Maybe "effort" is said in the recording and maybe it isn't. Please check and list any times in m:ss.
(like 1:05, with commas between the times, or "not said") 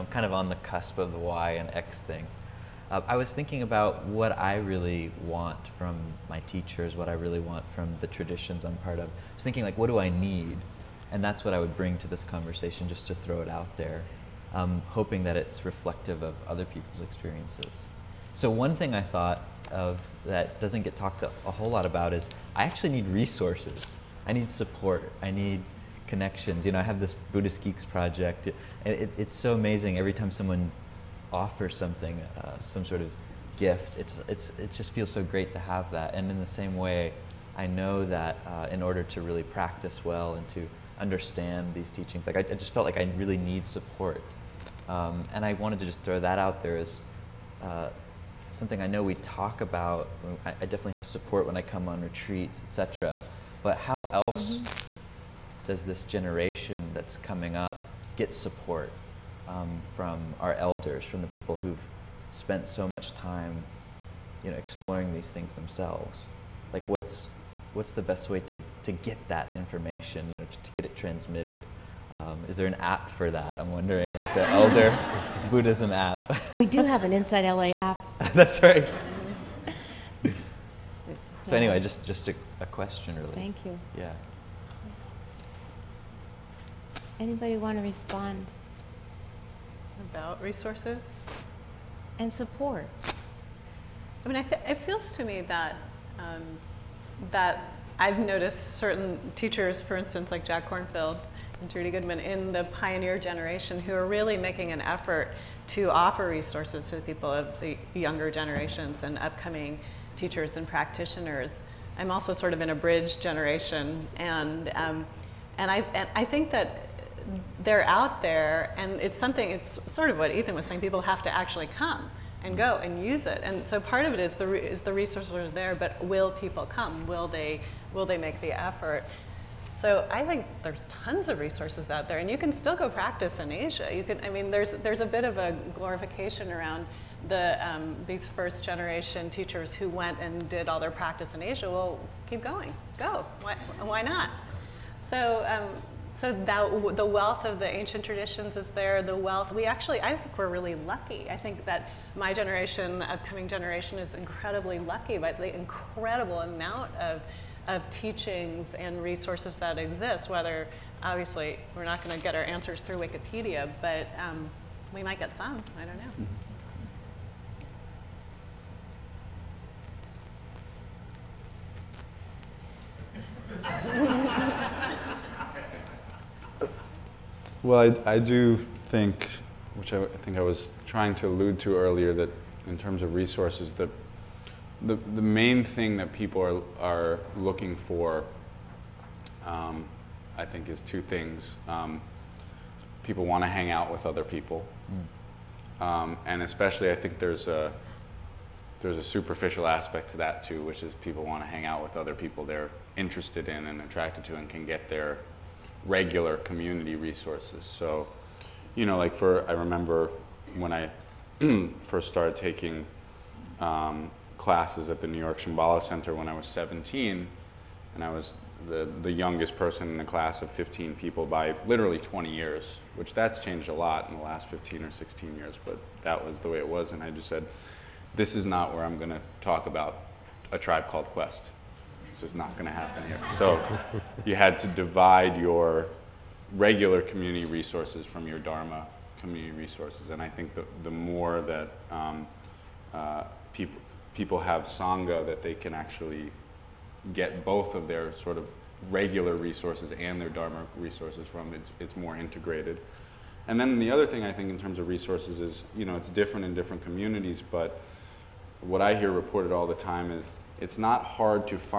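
1:44, 2:08.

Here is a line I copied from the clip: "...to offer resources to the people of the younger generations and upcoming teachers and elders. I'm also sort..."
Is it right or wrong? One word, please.
wrong.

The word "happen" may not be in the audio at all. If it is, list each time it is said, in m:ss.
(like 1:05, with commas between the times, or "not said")
3:52.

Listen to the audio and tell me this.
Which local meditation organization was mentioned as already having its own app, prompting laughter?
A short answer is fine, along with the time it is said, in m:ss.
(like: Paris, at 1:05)
Insight LA, at 1:17.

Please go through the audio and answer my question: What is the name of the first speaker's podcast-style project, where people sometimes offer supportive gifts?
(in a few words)
Buddhist Geeks.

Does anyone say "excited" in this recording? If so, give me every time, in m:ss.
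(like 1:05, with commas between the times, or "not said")
not said.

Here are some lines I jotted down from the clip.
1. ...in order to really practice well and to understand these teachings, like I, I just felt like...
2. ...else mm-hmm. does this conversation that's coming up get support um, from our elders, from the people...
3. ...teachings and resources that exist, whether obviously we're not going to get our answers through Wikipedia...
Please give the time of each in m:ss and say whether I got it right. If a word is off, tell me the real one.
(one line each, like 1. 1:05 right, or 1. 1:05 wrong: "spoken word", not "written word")
1. 0:38 right
2. 0:54 wrong: "generation", not "conversation"
3. 2:37 right.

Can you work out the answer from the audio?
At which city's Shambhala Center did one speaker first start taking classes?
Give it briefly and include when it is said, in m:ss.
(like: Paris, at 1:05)
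New York, at 3:35.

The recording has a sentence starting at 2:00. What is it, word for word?
People have to actually come and go and use it.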